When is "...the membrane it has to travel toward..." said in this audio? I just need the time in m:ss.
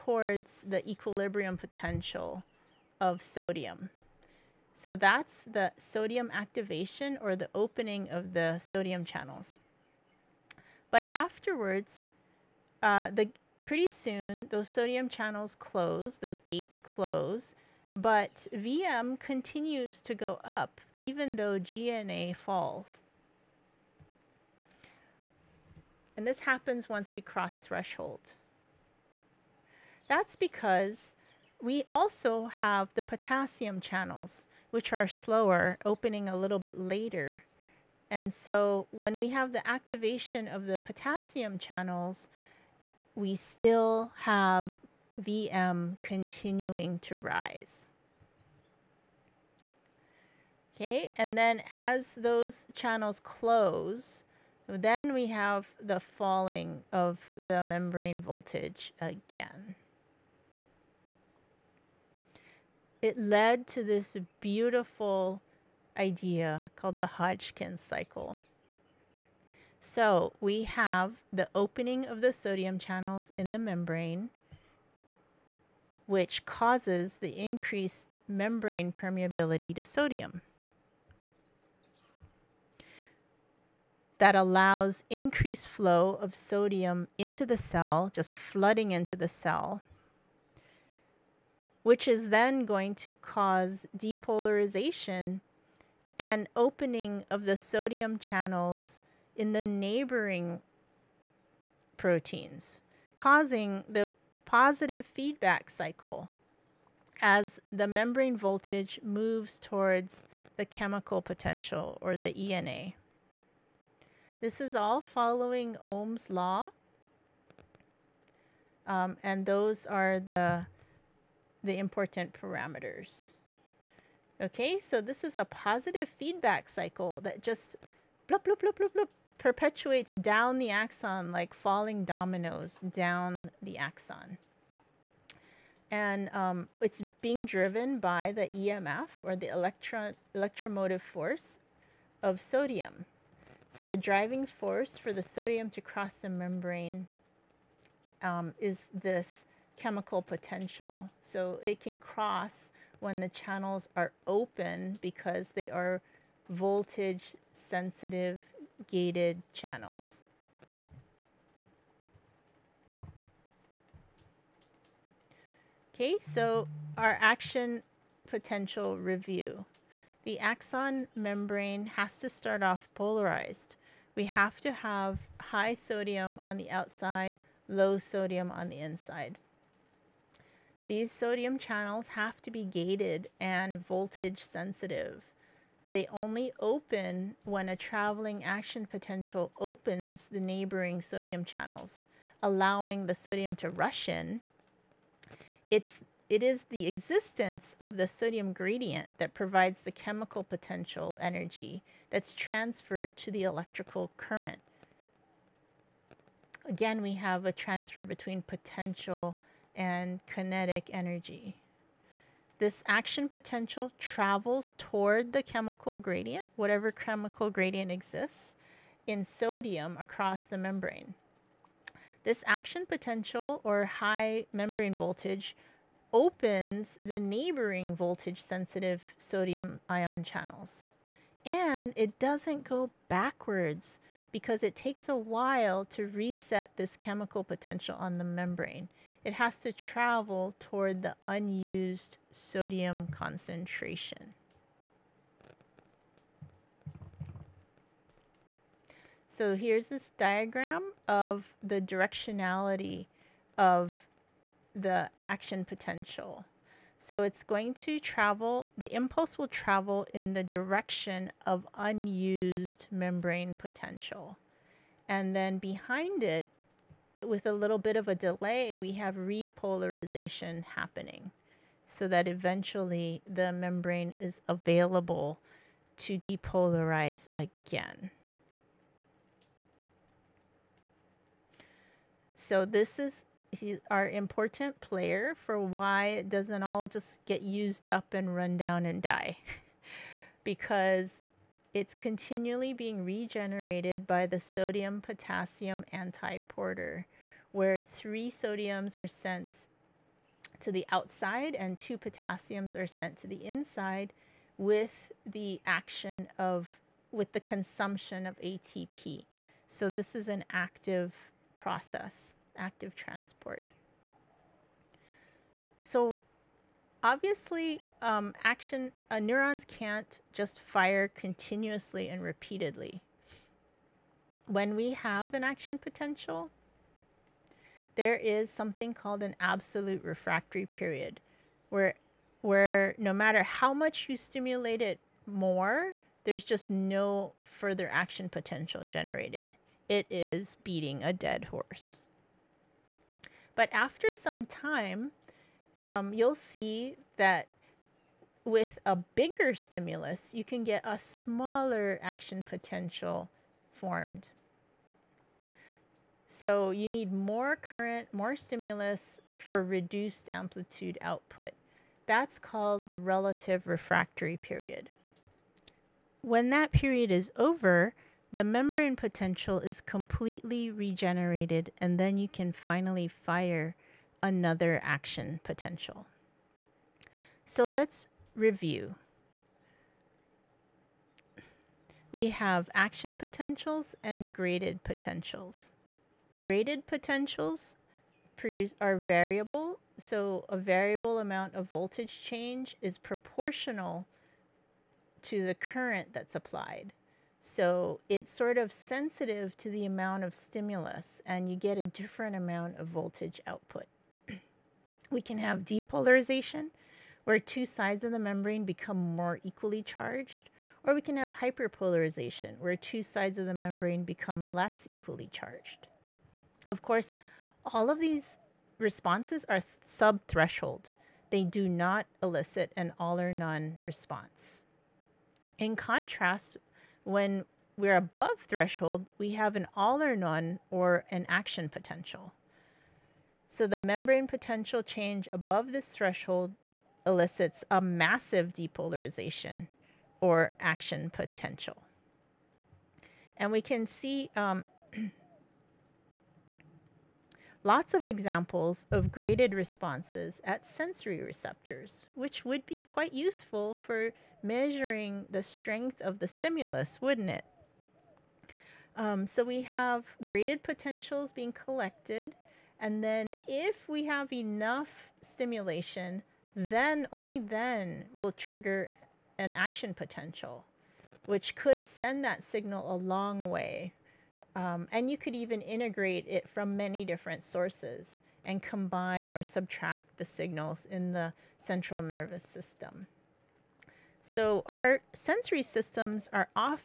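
3:58.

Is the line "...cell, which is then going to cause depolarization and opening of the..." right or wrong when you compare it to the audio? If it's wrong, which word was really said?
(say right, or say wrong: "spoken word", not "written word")
right.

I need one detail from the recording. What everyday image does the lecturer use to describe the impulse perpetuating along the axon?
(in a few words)
falling dominoes.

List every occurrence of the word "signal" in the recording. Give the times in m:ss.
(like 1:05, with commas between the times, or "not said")
7:52, 8:00.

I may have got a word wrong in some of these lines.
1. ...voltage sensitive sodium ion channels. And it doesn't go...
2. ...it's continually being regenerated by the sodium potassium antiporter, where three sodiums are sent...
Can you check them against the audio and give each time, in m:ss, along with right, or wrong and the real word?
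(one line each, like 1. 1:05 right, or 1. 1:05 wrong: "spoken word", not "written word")
1. 3:47 right
2. 4:51 right.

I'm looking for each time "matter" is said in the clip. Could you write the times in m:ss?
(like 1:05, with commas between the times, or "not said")
5:33.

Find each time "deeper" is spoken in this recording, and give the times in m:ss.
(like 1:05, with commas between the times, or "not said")
not said.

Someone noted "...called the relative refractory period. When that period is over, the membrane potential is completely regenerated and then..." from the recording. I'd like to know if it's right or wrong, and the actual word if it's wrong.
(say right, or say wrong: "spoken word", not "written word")
right.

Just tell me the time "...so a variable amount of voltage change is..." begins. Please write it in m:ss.
6:29.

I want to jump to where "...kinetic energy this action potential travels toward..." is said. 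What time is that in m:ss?
3:30.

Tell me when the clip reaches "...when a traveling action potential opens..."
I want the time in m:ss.
3:07.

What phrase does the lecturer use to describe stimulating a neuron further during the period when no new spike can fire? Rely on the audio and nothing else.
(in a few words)
beating a dead horse.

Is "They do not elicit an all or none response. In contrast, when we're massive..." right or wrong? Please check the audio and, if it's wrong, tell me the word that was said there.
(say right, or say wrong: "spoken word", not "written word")
wrong: "above", not "massive".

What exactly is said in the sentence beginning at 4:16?
So it's going to travel, the impulse will travel in the direction of unused membrane potential.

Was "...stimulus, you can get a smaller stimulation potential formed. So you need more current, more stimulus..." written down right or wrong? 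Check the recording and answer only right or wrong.
wrong.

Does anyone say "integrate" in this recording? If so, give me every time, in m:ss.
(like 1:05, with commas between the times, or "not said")
7:55.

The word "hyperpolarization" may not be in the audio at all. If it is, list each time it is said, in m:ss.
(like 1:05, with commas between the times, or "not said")
6:51.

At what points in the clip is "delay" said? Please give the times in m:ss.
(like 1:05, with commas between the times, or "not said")
4:28.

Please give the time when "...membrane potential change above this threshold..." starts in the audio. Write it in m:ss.
7:13.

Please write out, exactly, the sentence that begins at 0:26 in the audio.
And this happens once we cross threshold.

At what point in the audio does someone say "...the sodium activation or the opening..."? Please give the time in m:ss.
0:05.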